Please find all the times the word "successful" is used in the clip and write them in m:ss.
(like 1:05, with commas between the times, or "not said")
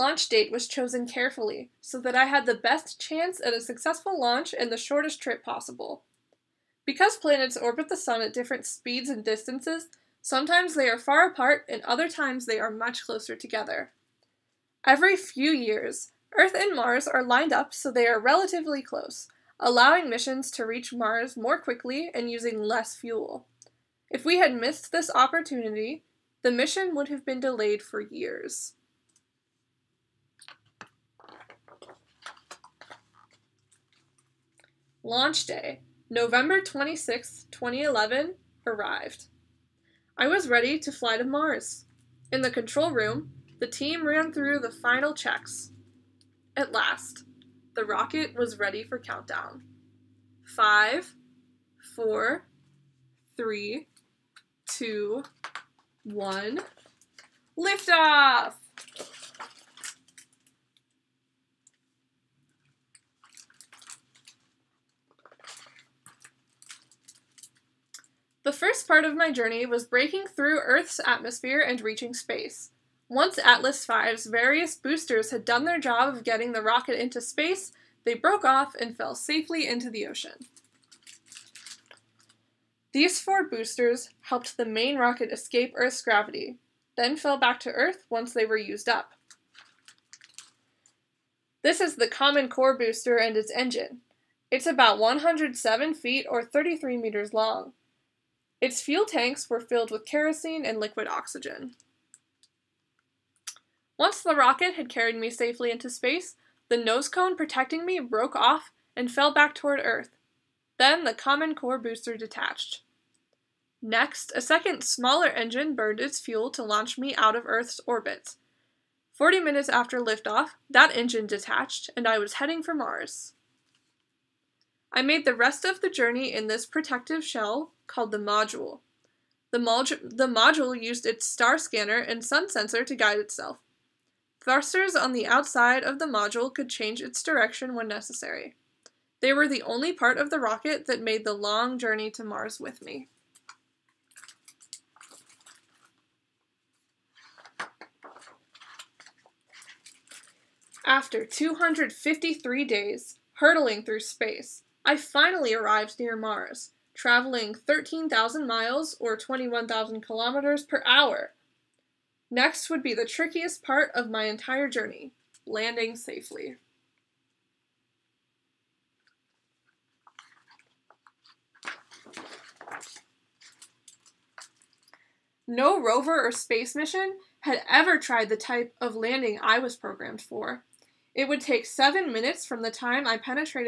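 0:03.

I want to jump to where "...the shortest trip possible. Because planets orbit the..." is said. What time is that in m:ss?
0:04.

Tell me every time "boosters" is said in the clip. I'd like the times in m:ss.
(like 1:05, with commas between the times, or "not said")
1:14, 1:23, 1:32, 1:51.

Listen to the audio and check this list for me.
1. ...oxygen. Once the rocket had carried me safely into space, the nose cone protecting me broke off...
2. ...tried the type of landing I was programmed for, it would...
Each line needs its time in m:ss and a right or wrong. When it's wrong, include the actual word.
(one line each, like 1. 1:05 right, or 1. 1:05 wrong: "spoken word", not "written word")
1. 1:41 right
2. 2:57 right.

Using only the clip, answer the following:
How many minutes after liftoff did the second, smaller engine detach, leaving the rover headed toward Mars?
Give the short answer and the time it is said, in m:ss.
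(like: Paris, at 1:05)
40, at 1:59.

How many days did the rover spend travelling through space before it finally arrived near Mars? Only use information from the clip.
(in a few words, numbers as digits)
253.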